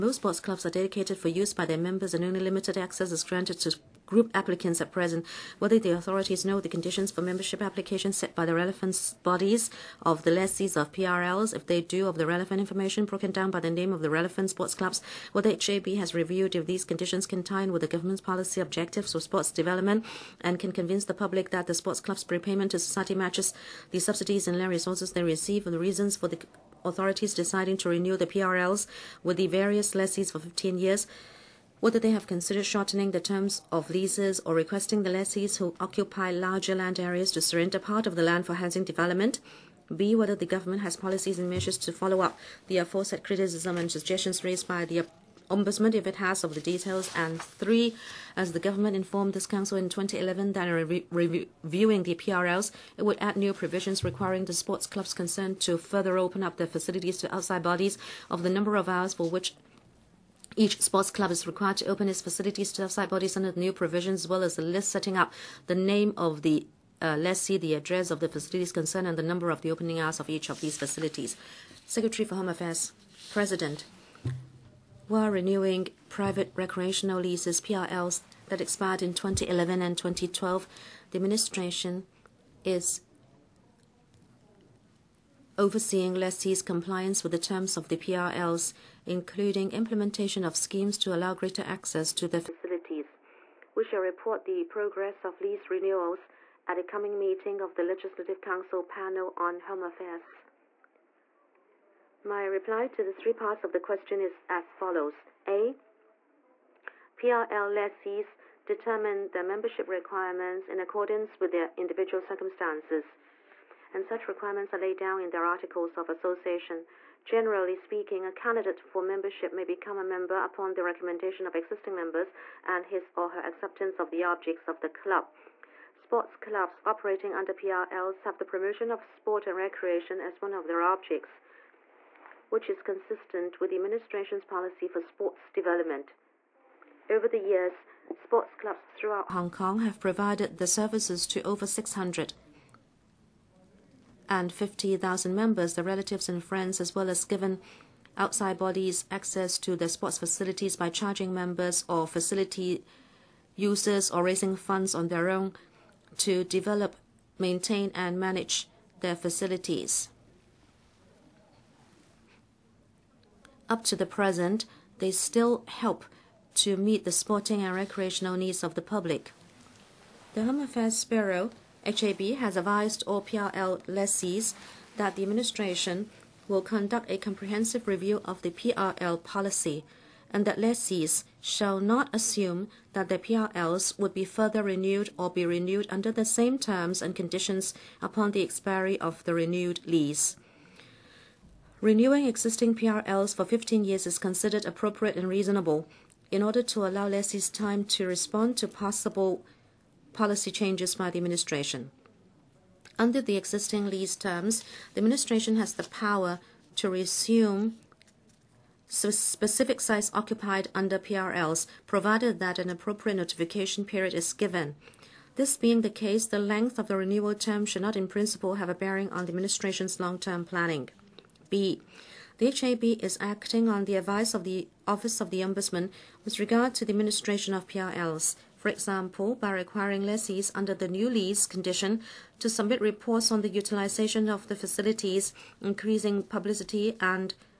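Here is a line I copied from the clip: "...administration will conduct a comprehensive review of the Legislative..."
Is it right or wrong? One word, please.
wrong.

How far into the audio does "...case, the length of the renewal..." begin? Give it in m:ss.
3:35.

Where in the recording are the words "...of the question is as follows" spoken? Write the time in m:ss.
1:43.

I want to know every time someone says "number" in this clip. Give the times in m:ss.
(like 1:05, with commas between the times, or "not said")
0:58, 1:09.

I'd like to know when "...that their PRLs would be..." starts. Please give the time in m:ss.
3:02.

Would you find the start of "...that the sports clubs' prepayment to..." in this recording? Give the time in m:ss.
0:21.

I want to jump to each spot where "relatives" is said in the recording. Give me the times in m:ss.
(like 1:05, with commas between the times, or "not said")
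2:25.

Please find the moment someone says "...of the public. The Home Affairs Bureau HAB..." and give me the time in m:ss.
2:48.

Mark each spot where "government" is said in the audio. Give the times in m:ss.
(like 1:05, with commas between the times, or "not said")
0:17, 0:40, 0:48.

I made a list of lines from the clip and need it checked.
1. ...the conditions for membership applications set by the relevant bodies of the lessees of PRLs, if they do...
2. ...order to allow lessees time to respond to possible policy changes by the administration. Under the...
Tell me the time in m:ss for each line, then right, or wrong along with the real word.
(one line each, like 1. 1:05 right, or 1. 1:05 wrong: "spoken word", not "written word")
1. 0:06 right
2. 3:16 right.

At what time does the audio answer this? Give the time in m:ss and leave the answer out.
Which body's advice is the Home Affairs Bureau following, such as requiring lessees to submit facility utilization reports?
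3:44.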